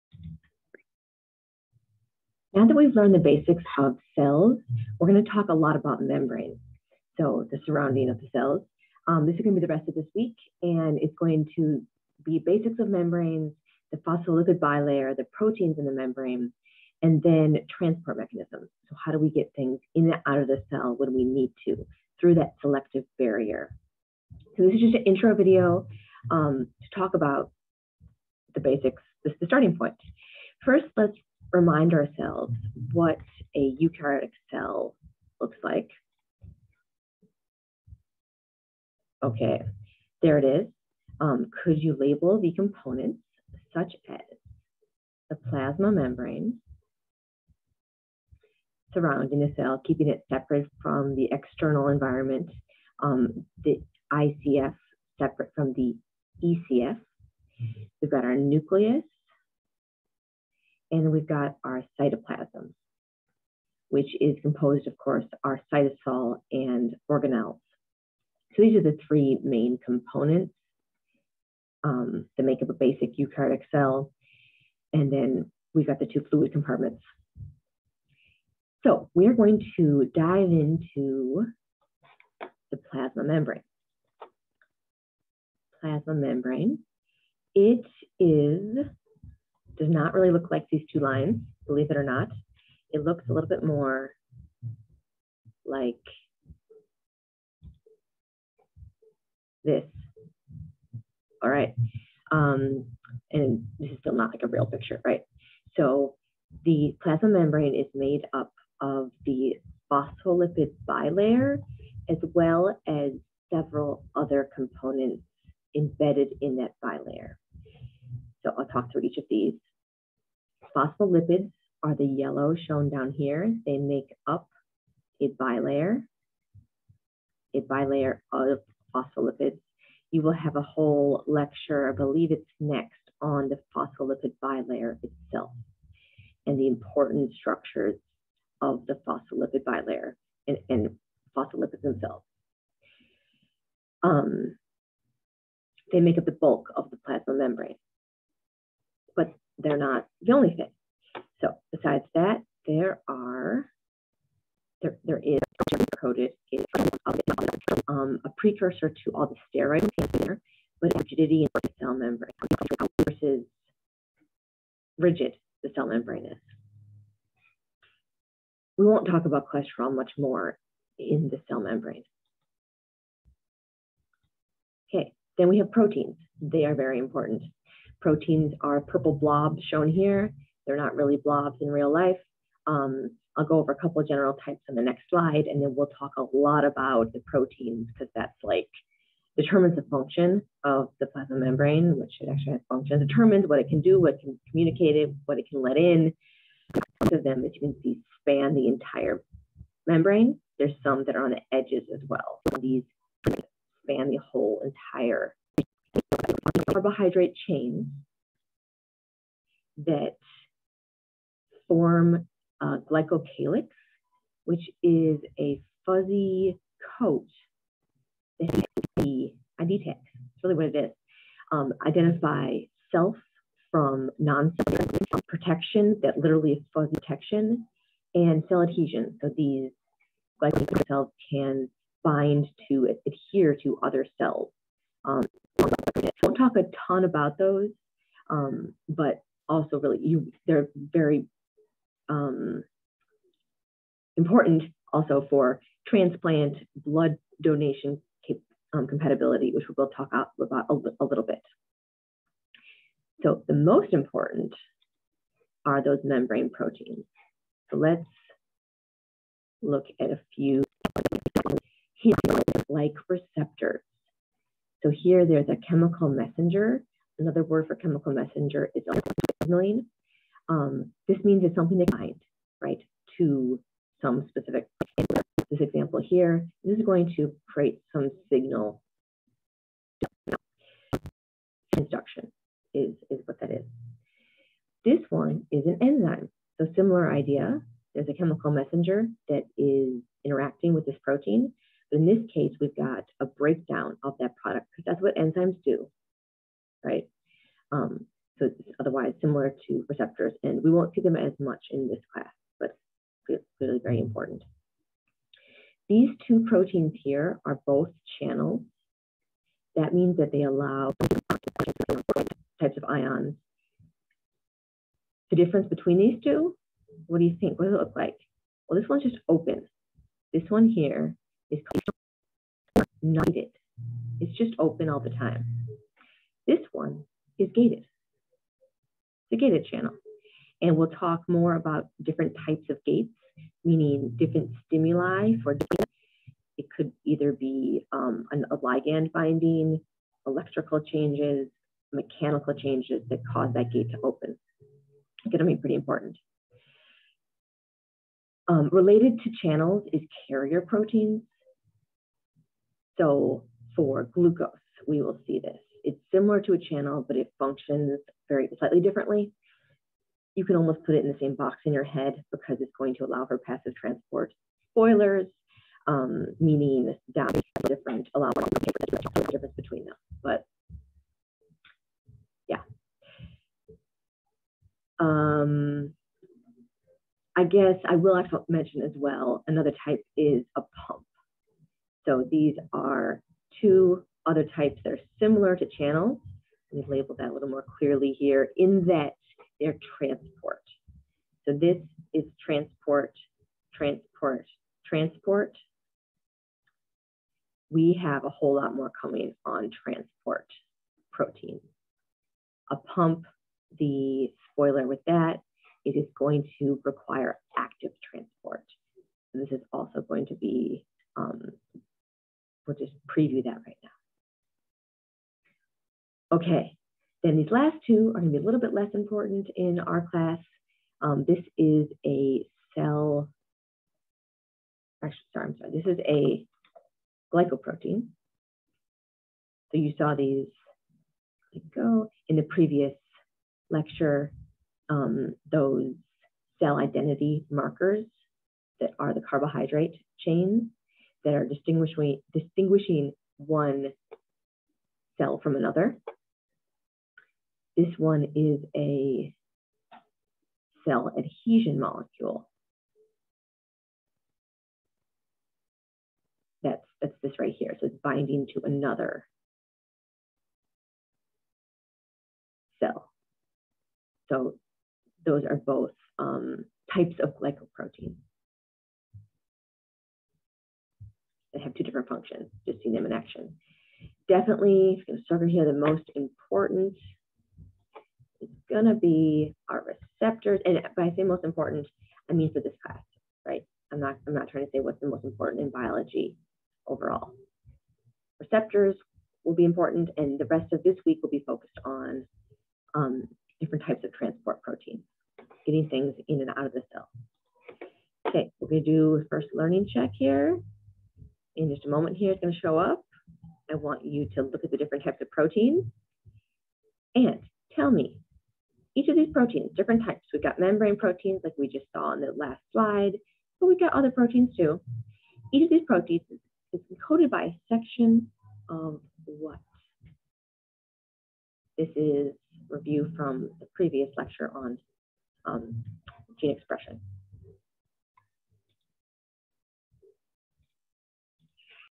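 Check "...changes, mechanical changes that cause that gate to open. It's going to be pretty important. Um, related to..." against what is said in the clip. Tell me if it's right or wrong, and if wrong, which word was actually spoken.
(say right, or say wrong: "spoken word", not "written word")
right.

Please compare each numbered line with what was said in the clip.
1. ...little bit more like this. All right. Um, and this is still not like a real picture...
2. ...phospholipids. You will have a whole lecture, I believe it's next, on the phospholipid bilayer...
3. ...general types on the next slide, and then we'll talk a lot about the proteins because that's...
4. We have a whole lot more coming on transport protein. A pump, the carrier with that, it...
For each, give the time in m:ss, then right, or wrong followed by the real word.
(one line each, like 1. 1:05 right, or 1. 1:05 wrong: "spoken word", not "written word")
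1. 1:33 right
2. 2:08 right
3. 3:04 right
4. 6:37 wrong: "spoiler", not "carrier".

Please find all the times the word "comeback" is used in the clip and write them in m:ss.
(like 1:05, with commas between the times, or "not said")
not said.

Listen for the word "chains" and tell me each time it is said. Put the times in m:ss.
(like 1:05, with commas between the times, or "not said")
3:27, 7:20.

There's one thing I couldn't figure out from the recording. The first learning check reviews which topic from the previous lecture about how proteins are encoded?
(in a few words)
gene expression.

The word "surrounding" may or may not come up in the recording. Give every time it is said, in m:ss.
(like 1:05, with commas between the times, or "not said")
0:07, 0:48.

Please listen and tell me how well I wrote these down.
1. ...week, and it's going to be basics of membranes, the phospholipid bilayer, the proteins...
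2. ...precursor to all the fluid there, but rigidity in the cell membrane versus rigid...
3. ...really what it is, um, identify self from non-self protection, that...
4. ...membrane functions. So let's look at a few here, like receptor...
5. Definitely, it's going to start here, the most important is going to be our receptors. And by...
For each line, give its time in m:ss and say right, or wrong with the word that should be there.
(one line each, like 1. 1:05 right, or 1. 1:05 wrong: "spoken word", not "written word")
1. 0:10 right
2. 2:38 wrong: "steroid", not "fluid"
3. 3:40 right
4. 4:16 wrong: "proteins", not "functions"
5. 7:54 right.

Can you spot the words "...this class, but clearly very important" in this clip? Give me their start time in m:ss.
5:01.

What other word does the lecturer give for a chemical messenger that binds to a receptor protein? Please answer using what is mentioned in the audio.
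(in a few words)
signaling.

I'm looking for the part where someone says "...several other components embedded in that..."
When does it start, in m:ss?
1:53.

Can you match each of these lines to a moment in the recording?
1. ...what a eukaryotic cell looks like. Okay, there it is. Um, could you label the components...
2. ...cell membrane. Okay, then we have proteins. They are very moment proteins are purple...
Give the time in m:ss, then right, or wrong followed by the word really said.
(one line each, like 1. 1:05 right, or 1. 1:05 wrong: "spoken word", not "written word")
1. 0:32 right
2. 2:51 wrong: "important", not "moment".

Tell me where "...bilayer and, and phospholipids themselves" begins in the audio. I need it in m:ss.
2:19.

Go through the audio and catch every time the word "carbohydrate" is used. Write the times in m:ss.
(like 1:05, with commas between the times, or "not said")
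3:26, 7:19.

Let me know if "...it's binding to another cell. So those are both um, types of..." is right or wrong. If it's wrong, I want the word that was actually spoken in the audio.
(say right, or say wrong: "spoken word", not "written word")
right.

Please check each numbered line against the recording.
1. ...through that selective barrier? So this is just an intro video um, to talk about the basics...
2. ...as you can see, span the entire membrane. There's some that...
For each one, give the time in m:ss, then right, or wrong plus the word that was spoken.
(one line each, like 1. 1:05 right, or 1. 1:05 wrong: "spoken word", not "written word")
1. 0:22 right
2. 3:17 right.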